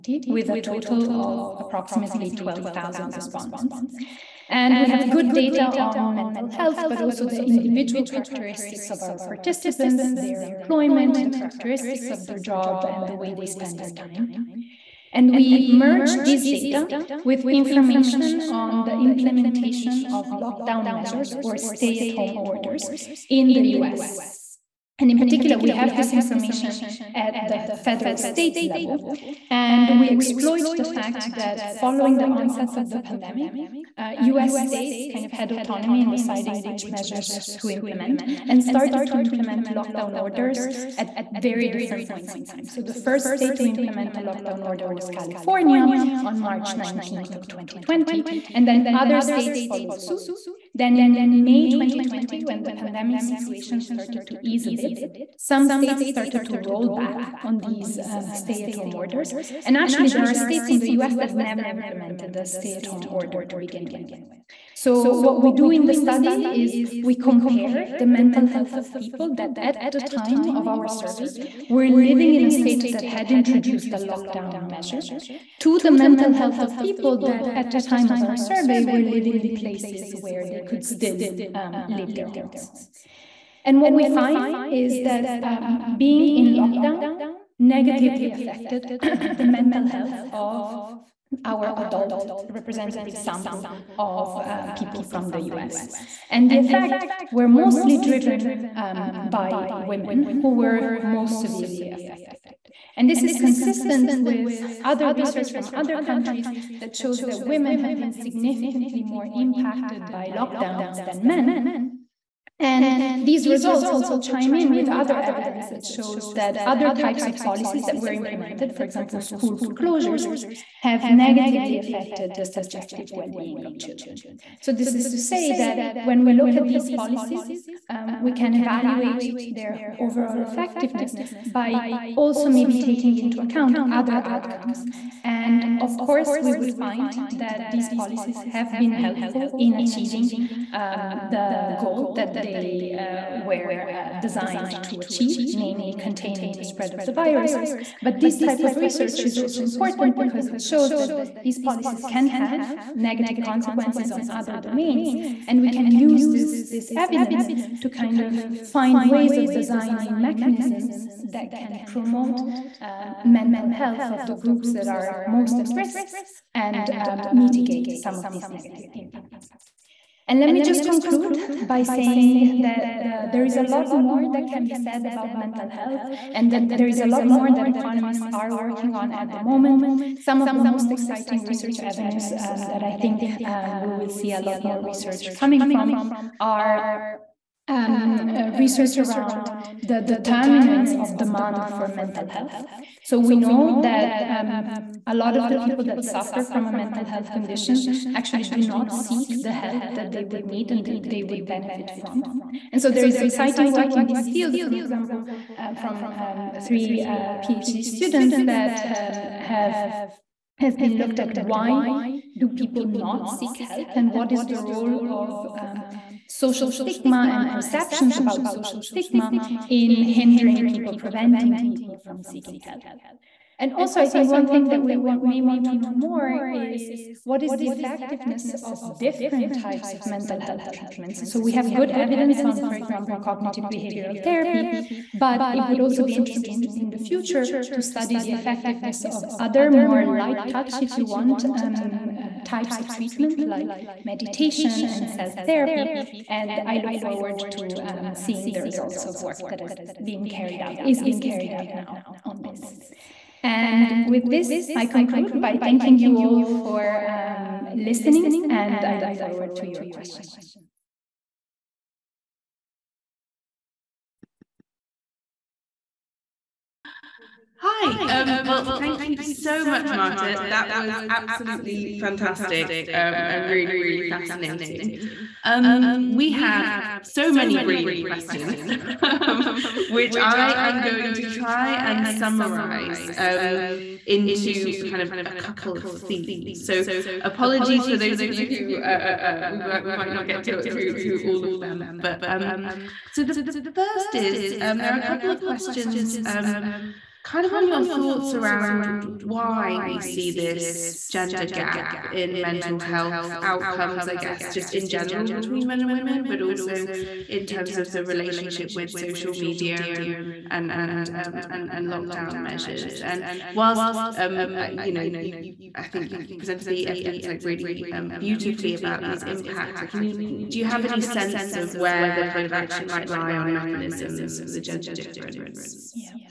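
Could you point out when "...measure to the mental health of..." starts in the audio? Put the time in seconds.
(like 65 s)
74 s.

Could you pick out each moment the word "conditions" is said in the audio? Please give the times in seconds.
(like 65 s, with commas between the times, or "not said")
197 s.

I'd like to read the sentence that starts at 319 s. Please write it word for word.
Like, can you do you have any sense of where the kind of action might lie on mechanisms for the gender difference?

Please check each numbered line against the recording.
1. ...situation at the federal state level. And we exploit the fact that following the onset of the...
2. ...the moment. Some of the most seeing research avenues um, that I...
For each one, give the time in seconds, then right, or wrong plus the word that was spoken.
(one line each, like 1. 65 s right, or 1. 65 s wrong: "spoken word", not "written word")
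1. 26 s wrong: "information", not "situation"
2. 179 s wrong: "exciting", not "seeing".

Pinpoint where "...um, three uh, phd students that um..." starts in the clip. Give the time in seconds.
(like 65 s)
206 s.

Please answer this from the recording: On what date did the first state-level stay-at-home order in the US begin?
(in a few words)
March 19th 2020.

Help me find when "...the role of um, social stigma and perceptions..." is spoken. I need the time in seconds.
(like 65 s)
214 s.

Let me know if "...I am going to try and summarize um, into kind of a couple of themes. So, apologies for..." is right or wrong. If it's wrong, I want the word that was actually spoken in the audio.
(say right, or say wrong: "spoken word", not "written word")
right.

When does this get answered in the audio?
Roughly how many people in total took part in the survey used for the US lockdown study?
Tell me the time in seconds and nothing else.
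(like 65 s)
2 s.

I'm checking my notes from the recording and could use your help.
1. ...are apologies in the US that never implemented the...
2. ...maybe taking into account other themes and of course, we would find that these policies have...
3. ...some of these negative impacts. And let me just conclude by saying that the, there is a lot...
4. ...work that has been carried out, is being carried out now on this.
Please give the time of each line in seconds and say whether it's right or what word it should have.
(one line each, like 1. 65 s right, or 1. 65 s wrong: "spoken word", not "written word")
1. 60 s wrong: "states", not "apologies"
2. 132 s wrong: "outcomes", not "themes"
3. 167 s right
4. 249 s right.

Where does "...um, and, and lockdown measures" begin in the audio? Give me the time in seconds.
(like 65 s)
311 s.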